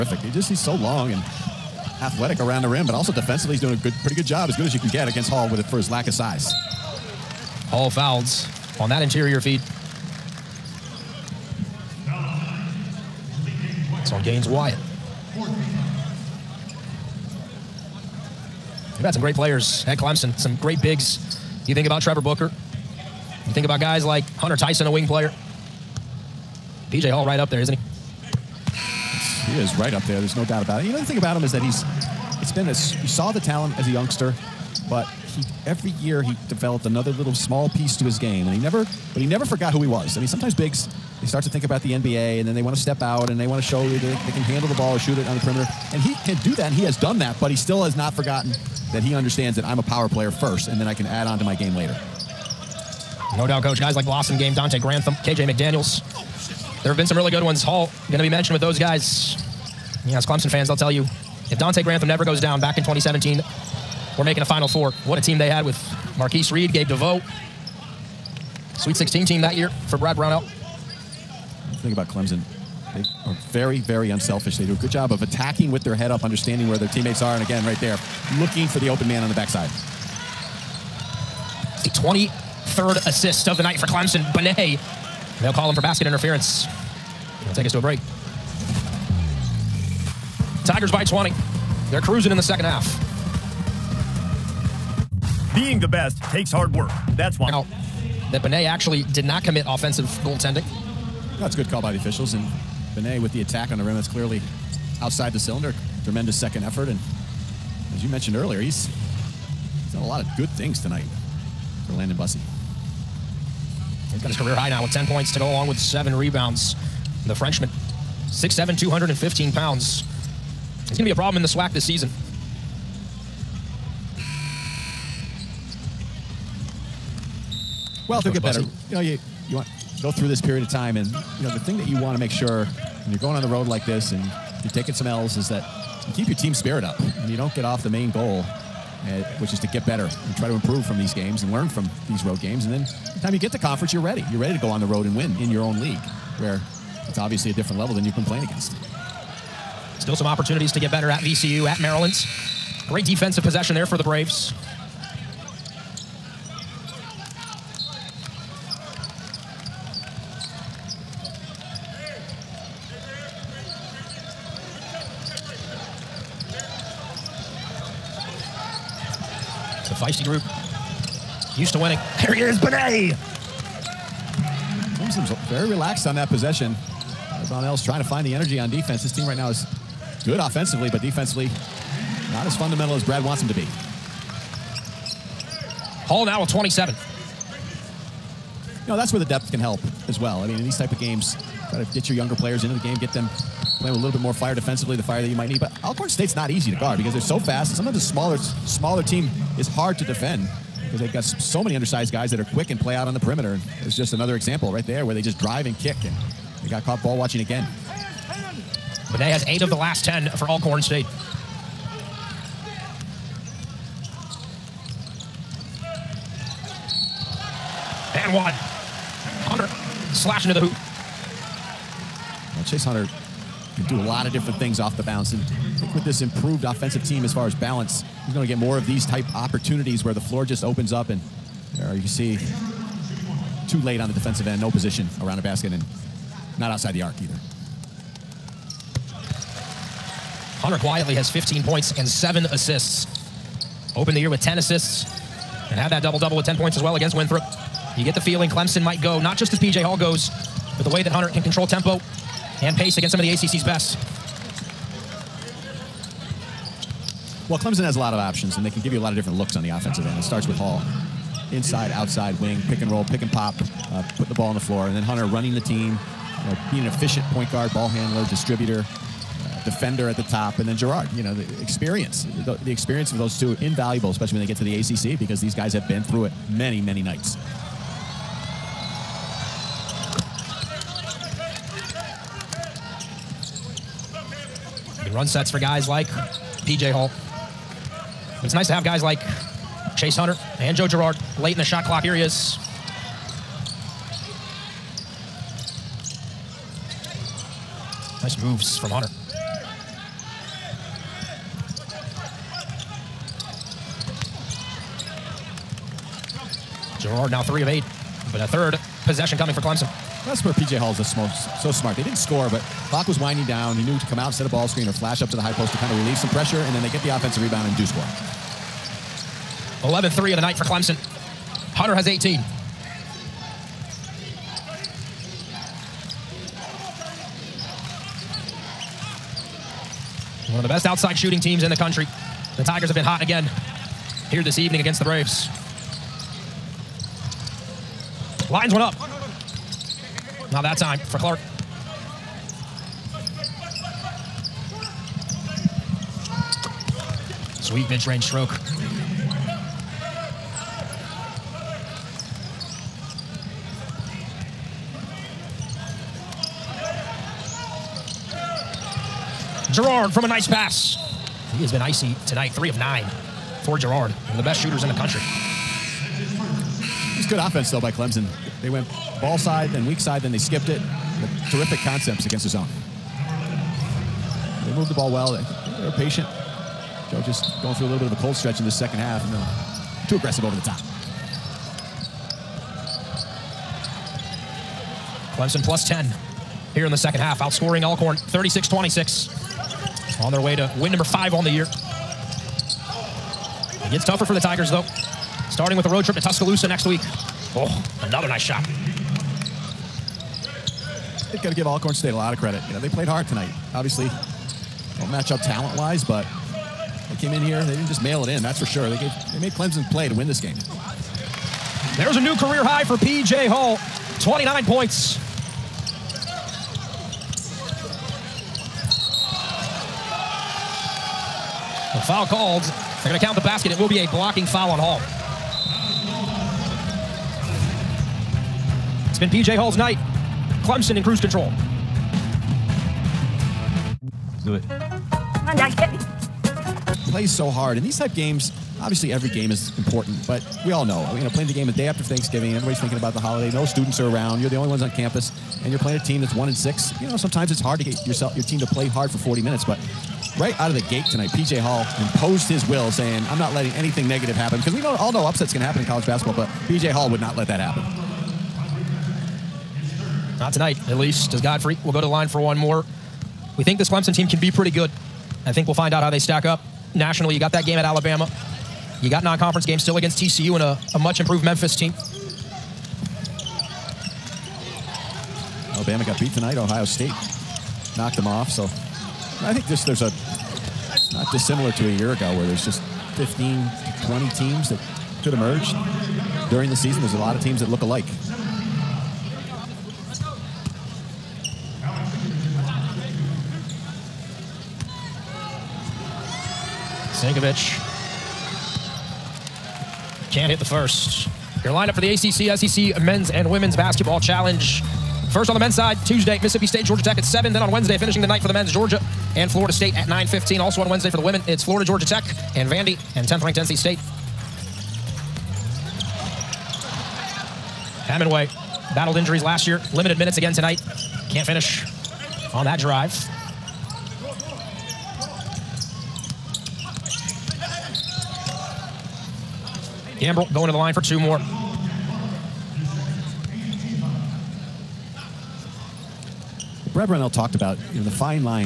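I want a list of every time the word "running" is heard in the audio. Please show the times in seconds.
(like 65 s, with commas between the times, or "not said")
265 s.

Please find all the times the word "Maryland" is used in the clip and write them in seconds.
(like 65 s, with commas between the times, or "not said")
151 s.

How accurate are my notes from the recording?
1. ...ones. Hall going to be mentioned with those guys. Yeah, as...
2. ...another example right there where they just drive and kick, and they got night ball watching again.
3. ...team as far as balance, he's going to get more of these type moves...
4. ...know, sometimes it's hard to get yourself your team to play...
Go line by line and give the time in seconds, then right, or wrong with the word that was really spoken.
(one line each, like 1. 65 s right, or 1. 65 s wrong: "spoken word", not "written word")
1. 57 s right
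2. 204 s wrong: "caught", not "night"
3. 227 s wrong: "opportunities", not "moves"
4. 447 s right.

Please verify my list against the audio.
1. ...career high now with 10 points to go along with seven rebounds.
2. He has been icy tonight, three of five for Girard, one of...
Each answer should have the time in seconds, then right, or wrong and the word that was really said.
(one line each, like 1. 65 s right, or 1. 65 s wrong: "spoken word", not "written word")
1. 114 s right
2. 361 s wrong: "nine", not "five".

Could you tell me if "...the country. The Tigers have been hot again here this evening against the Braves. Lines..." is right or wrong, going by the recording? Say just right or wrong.
right.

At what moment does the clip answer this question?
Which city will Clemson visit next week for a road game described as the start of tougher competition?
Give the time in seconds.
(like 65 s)
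396 s.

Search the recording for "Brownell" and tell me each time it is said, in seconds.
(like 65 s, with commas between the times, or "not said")
70 s, 537 s.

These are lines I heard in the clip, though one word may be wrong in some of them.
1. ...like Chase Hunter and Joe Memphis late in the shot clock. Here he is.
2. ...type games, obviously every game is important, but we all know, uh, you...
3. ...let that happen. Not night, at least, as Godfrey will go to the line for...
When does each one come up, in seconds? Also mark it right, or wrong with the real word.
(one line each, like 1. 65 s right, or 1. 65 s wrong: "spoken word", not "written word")
1. 289 s wrong: "Girard", not "Memphis"
2. 437 s right
3. 457 s wrong: "tonight", not "night".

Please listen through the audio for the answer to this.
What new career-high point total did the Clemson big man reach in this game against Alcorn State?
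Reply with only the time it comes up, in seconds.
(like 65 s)
414 s.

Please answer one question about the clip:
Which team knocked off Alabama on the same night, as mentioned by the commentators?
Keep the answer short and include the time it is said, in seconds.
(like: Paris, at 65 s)
Ohio State, at 476 s.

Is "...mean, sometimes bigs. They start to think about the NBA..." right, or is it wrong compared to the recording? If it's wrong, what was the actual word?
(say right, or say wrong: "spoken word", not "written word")
right.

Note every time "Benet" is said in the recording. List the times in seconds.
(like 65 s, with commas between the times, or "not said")
84 s, 98 s, 102 s, 172 s, 209 s.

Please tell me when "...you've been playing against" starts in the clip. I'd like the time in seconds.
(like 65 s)
148 s.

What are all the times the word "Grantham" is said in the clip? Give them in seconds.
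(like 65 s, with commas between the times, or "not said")
54 s, 61 s.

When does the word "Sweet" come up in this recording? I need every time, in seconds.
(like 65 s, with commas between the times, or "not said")
68 s, 347 s.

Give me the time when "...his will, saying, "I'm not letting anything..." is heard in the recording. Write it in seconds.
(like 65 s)
452 s.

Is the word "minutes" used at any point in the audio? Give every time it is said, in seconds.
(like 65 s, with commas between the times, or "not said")
449 s, 520 s.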